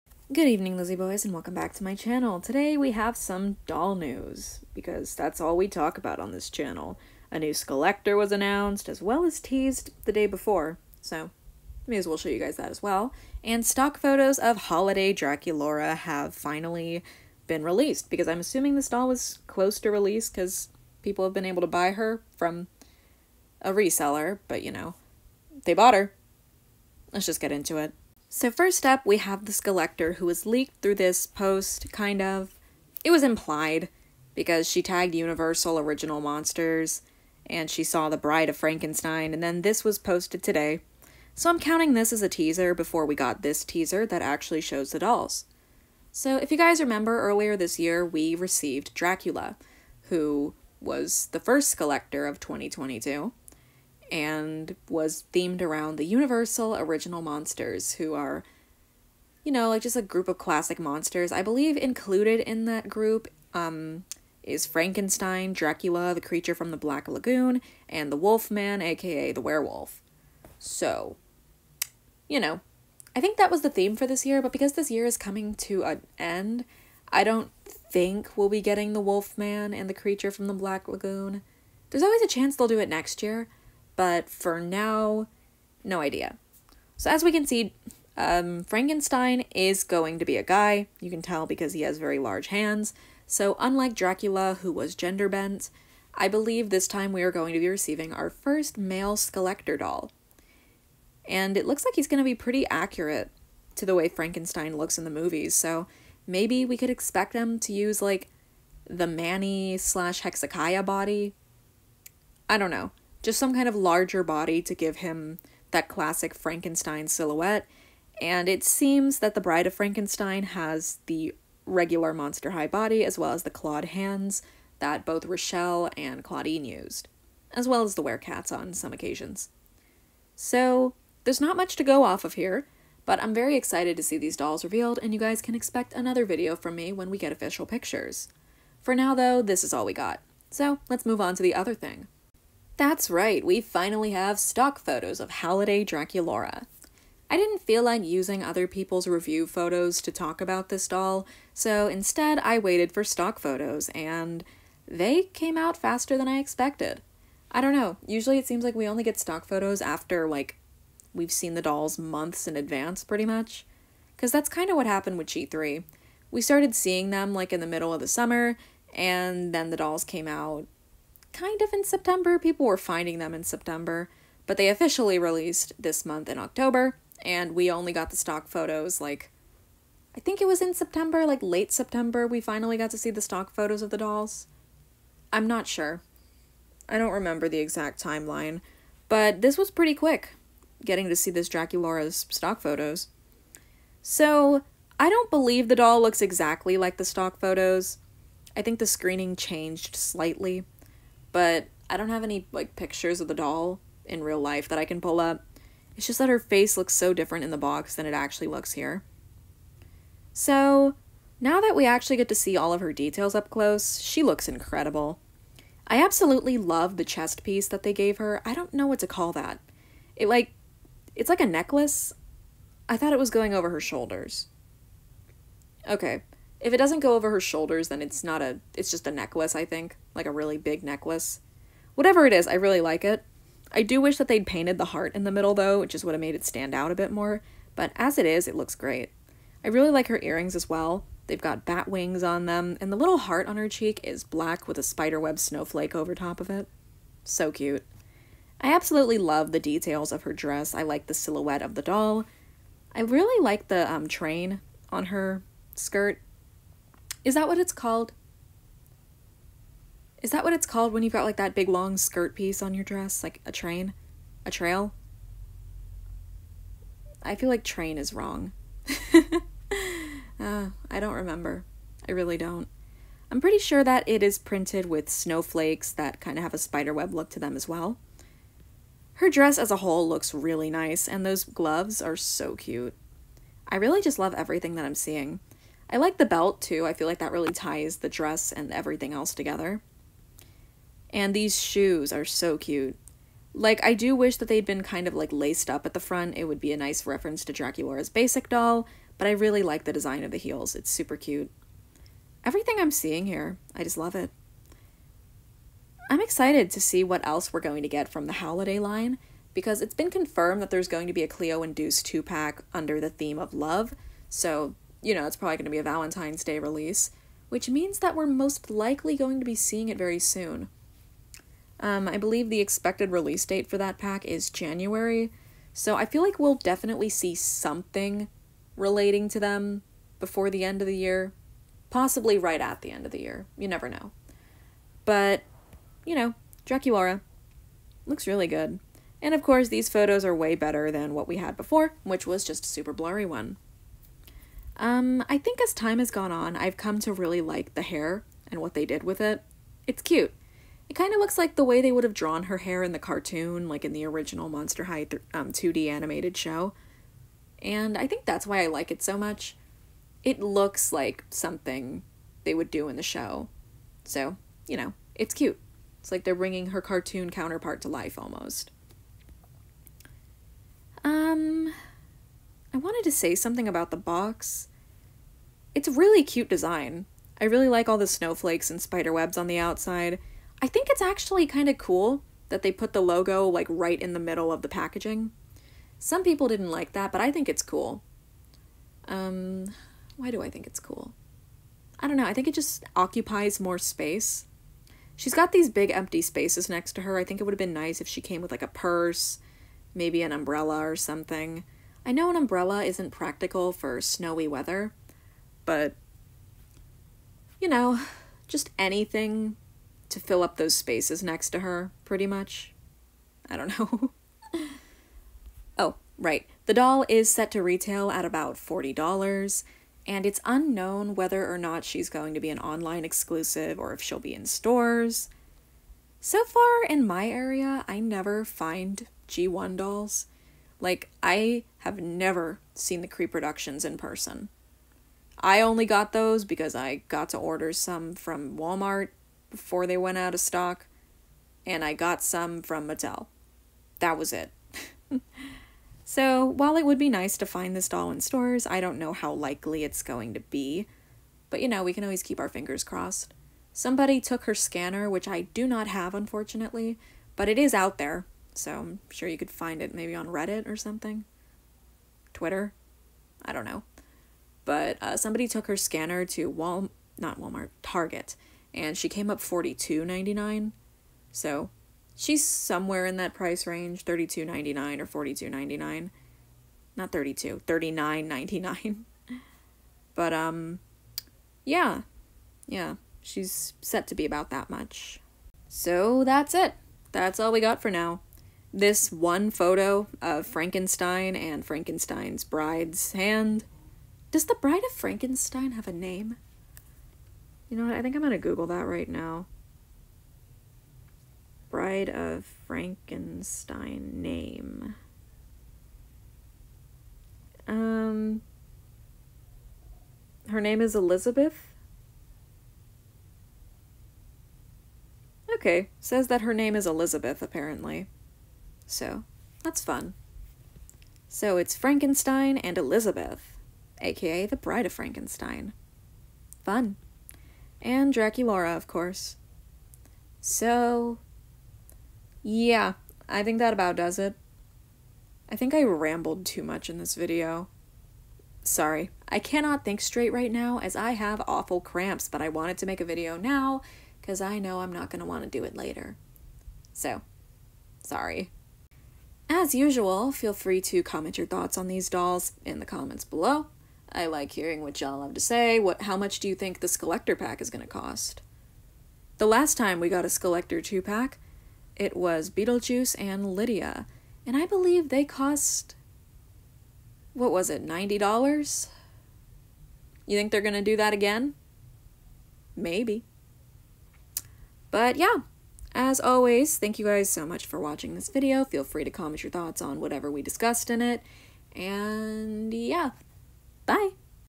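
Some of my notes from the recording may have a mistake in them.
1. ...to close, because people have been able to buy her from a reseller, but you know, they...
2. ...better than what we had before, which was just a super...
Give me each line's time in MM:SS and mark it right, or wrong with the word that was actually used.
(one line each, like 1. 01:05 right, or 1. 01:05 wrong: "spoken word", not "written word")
1. 00:19 wrong: "release", not "close"
2. 05:40 right.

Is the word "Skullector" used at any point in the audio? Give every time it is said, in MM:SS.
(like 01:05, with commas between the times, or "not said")
00:29, 00:51, 01:39.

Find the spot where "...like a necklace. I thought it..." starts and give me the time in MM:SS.
03:41.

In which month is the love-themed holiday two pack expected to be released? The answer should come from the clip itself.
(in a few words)
January.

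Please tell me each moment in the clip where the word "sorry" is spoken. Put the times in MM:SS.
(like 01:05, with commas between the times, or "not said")
08:58, 09:08.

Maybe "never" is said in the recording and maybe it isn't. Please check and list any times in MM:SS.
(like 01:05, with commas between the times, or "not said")
05:33, 07:07, 07:12.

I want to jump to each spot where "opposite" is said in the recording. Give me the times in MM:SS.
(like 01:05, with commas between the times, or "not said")
not said.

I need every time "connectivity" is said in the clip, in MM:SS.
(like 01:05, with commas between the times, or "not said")
not said.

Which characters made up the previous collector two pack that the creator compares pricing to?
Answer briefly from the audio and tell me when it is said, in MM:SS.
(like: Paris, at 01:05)
Beetlejuice and Lydia, at 09:22.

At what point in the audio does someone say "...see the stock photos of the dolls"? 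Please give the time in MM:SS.
03:02.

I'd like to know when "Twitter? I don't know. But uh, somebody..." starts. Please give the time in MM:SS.
07:42.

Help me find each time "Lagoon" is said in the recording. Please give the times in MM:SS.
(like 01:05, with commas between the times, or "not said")
01:07, 01:20.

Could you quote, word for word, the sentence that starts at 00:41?
So I'm counting this as a teaser before we got this teaser that actually shows the dolls.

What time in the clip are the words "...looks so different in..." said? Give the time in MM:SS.
03:26.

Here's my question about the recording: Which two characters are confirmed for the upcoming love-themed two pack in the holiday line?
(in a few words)
Cleo and Deuce.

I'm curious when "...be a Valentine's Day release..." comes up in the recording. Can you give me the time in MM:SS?
05:15.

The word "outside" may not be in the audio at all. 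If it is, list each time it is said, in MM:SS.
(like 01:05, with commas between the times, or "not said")
06:19.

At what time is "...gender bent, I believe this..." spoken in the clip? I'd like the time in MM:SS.
01:34.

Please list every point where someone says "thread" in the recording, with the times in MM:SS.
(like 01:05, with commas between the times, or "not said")
not said.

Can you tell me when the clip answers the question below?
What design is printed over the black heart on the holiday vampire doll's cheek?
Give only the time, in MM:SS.
04:04.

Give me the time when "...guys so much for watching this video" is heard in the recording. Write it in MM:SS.
09:37.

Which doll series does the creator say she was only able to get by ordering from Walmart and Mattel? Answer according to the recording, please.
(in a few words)
Creeproductions.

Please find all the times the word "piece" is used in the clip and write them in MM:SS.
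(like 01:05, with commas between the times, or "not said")
03:37, 04:22.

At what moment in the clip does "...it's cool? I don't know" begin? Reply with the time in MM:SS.
06:30.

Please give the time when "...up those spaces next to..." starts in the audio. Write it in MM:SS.
06:50.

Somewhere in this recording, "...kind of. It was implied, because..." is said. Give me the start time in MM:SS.
00:31.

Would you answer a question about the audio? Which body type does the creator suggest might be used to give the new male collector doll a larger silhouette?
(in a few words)
Manny slash Hexiciah body.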